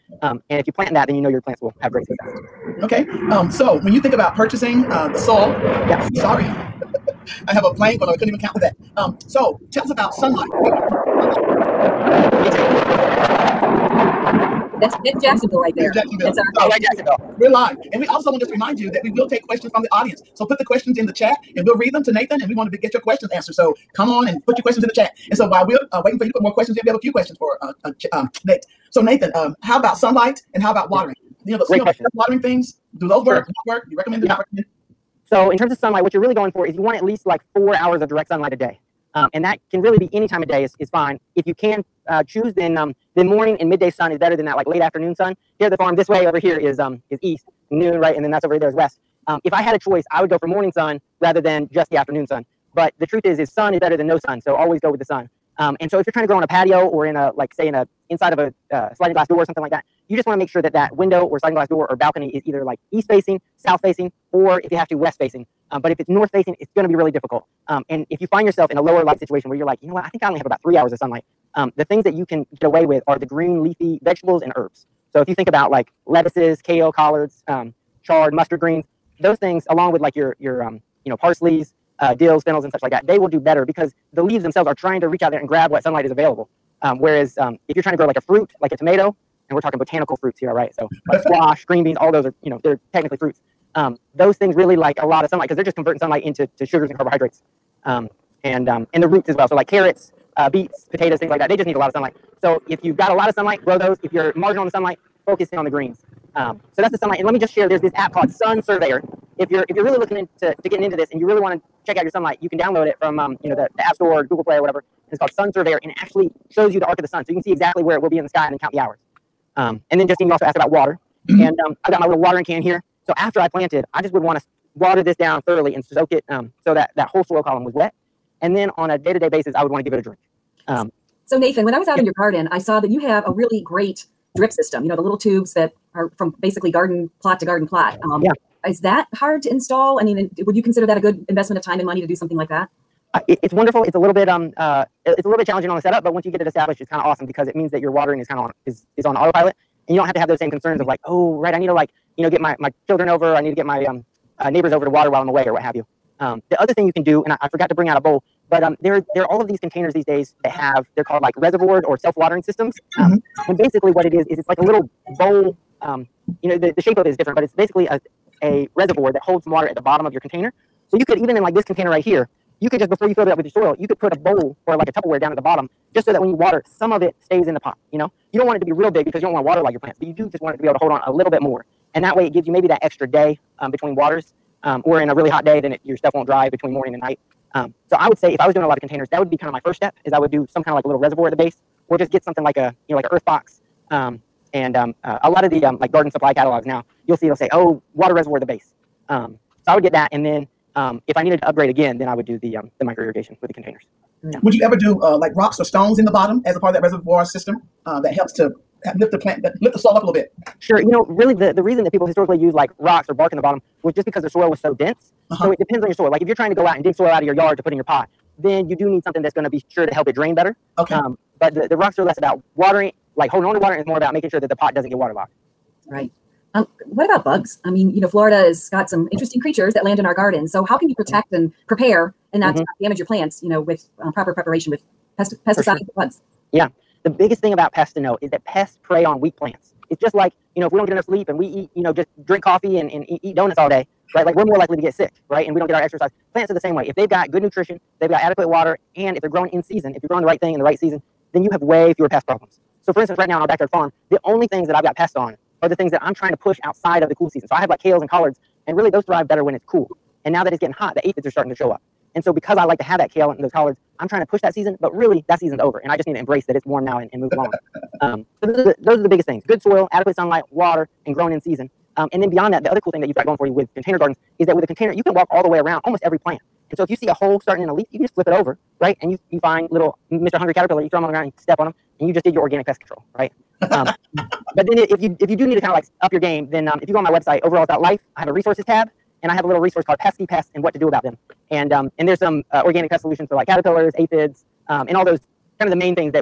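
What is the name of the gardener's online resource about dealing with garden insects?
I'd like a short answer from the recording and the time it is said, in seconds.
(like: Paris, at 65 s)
Pesky pests and what to do about them, at 289 s.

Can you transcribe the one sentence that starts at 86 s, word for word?
Um, whereas um, if you're trying to grow like a fruit, like a tomato, and we're talking botanical fruits here, all right?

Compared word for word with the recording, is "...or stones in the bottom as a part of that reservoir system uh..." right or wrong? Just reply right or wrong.
right.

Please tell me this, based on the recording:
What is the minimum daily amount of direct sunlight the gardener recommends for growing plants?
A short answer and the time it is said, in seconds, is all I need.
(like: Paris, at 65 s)
4 hours, at 37 s.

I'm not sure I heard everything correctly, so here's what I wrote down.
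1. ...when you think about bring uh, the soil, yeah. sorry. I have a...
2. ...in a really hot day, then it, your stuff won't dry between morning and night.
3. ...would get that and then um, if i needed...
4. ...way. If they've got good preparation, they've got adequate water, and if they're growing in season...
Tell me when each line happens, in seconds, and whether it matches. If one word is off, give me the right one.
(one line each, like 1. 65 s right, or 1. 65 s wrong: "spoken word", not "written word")
1. 3 s wrong: "purchasing", not "bring"
2. 185 s right
3. 199 s right
4. 246 s wrong: "nutrition", not "preparation".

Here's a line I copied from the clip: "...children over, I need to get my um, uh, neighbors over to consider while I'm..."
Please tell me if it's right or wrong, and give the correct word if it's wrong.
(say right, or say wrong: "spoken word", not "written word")
wrong: "water", not "consider".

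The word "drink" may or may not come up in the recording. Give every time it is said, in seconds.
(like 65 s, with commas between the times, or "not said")
130 s, 242 s.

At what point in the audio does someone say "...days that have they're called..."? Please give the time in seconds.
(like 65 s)
160 s.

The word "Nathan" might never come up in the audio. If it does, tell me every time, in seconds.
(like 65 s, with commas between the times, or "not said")
22 s, 29 s, 131 s.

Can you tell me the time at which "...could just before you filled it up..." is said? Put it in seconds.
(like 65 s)
172 s.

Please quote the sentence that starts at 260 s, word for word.
And now that it's getting hot, the aphids are starting to show up.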